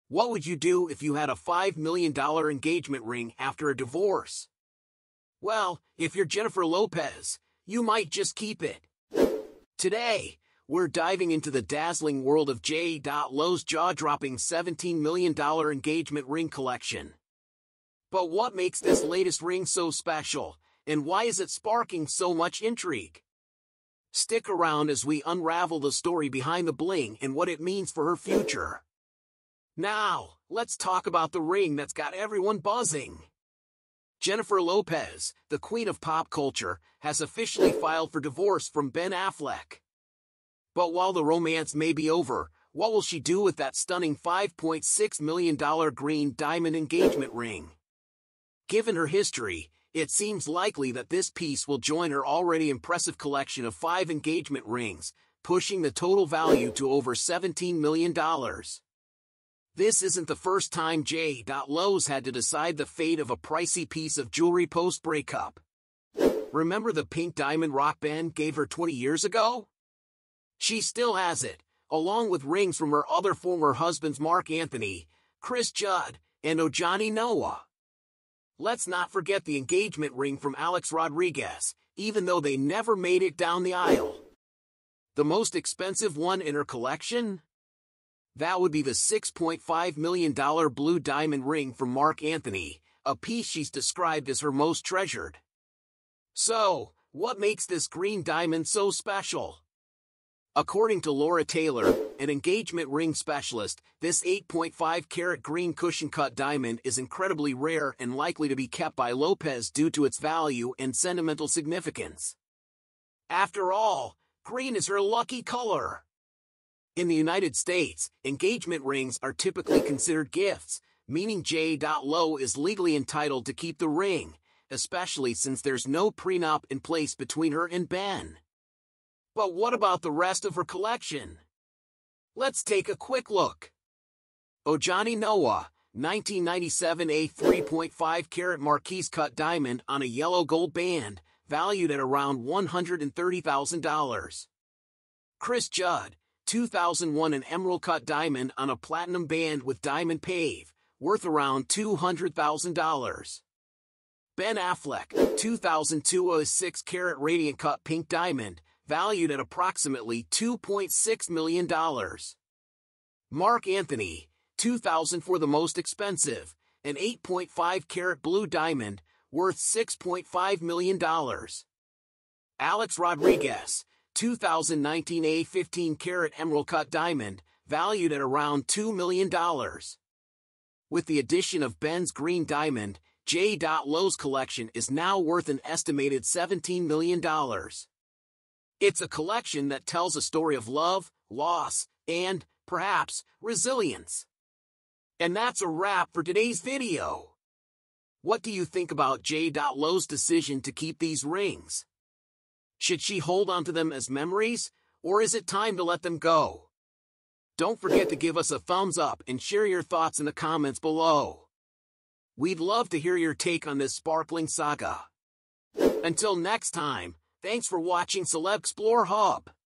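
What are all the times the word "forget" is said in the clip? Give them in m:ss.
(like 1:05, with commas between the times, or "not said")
1:19, 3:27.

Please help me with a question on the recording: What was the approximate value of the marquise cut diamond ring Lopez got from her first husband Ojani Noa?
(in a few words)
$130,000.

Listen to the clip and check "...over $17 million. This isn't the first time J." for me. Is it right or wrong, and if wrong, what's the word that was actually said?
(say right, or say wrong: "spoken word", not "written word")
right.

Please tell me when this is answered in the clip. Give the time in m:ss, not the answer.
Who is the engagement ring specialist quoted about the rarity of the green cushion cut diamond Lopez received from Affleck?
1:41.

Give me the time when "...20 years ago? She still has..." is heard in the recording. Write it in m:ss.
1:08.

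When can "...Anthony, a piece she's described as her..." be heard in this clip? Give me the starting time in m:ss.
1:32.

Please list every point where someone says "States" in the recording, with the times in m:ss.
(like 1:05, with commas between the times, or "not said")
1:57.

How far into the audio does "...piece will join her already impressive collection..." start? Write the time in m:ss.
0:51.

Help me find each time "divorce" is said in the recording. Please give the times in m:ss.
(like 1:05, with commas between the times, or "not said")
0:03, 0:38.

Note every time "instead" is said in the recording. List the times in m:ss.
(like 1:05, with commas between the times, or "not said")
not said.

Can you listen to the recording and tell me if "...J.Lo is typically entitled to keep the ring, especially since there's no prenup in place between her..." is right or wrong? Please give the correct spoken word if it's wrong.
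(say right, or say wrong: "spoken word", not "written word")
wrong: "legally", not "typically".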